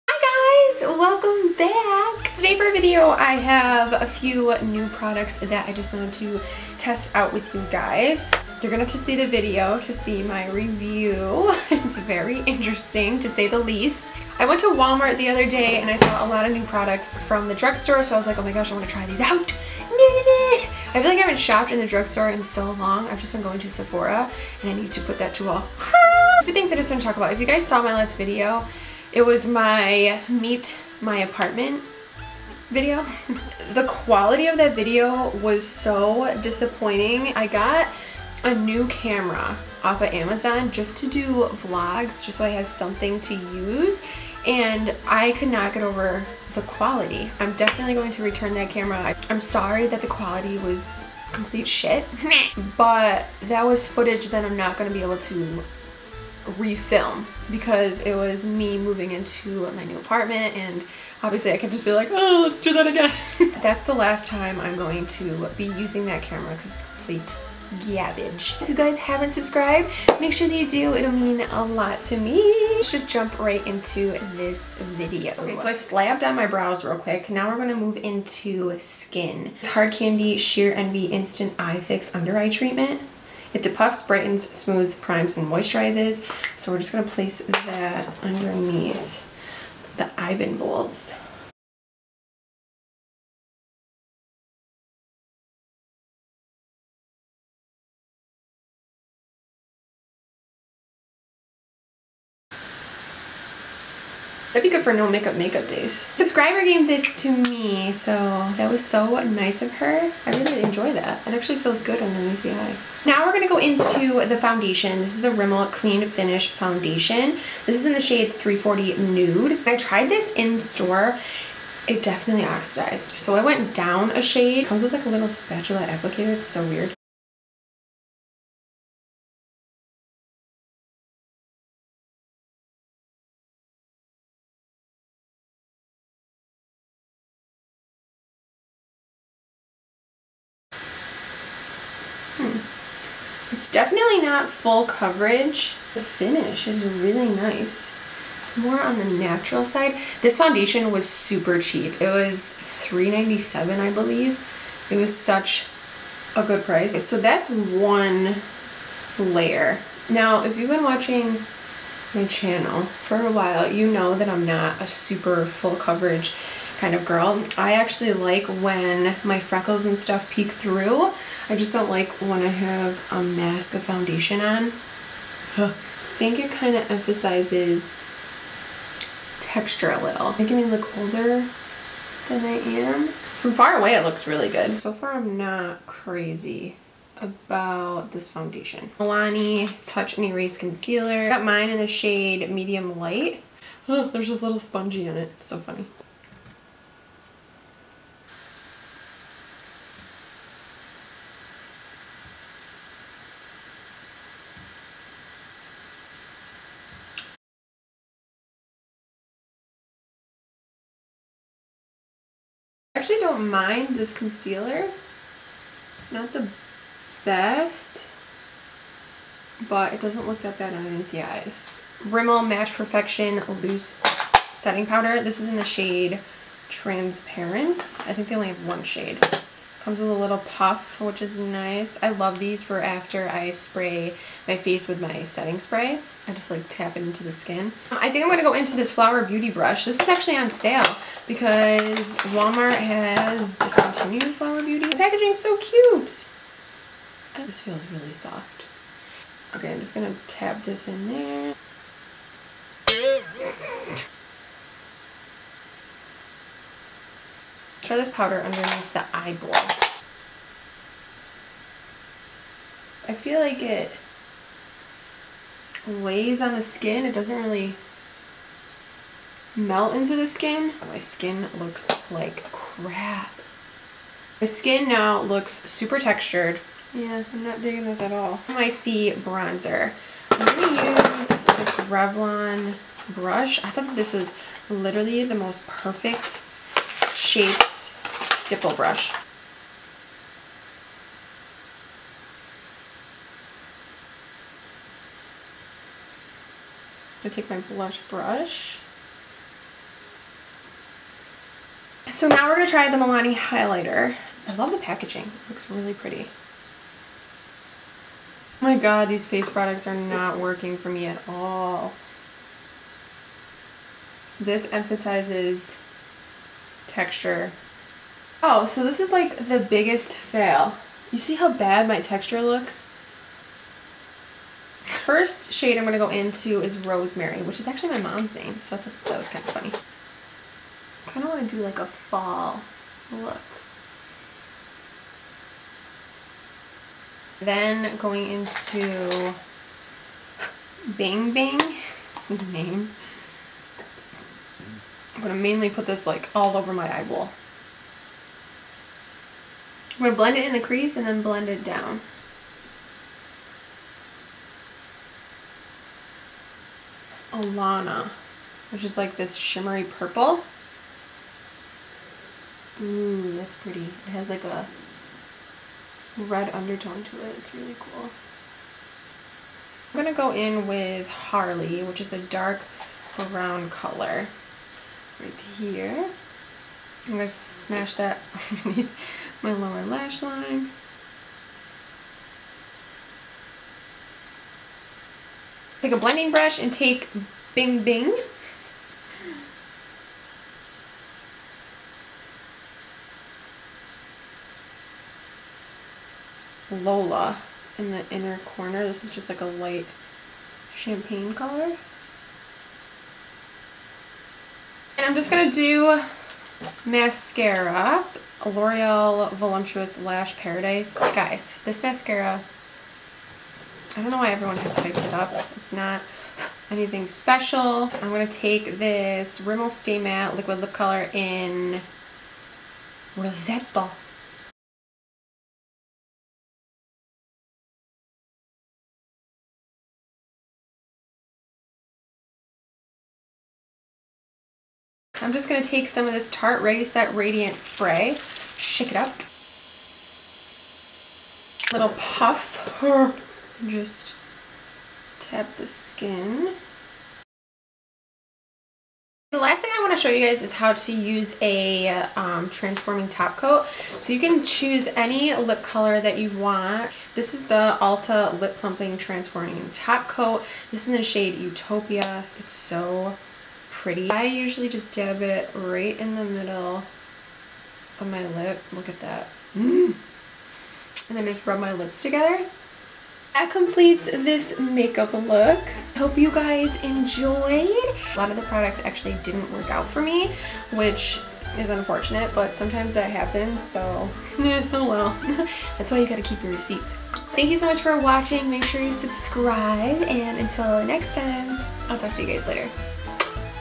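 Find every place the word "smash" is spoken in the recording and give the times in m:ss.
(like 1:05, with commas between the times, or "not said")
6:17.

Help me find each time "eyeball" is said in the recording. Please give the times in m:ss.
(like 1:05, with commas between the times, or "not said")
4:19, 5:46.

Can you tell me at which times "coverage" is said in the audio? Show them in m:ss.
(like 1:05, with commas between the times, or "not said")
2:24, 2:45.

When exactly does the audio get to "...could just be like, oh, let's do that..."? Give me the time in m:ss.
1:01.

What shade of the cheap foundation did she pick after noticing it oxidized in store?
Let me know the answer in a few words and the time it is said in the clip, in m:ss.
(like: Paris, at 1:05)
340 Nude, at 1:58.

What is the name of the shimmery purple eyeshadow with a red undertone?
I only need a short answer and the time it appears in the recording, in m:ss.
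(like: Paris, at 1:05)
Alana, at 5:57.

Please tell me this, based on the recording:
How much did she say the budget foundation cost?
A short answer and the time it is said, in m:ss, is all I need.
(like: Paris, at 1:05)
$3.97, at 2:32.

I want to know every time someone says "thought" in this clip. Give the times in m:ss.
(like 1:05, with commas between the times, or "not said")
4:43, 5:28.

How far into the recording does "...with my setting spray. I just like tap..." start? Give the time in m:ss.
3:54.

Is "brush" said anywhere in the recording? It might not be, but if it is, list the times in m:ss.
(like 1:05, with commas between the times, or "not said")
3:59, 4:43, 4:48, 4:58, 6:26.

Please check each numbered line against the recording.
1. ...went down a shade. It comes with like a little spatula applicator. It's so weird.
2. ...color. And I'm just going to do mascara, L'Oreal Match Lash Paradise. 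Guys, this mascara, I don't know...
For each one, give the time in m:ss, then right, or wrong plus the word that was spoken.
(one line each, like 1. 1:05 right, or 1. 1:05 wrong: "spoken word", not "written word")
1. 2:03 right
2. 6:41 wrong: "Voluminous", not "Match".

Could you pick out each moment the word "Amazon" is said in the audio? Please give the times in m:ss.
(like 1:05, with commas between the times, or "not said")
0:40.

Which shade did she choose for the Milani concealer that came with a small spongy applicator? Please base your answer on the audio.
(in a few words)
Medium Light.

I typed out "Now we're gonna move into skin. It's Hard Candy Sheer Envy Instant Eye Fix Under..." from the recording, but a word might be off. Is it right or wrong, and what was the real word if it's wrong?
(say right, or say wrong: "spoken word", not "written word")
right.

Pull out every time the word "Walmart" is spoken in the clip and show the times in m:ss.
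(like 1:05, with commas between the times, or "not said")
0:14, 4:02.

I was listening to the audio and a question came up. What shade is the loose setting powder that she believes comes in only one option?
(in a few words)
Transparent.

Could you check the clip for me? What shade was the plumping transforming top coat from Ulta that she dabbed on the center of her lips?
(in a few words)
Utopia.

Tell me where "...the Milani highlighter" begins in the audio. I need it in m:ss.
5:02.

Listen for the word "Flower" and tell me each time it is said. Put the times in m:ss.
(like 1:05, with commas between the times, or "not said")
3:58, 4:04.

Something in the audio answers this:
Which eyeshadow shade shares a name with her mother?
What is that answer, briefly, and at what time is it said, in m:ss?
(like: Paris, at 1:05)
Rosemary, at 5:26.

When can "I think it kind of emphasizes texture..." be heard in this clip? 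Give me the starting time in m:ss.
2:55.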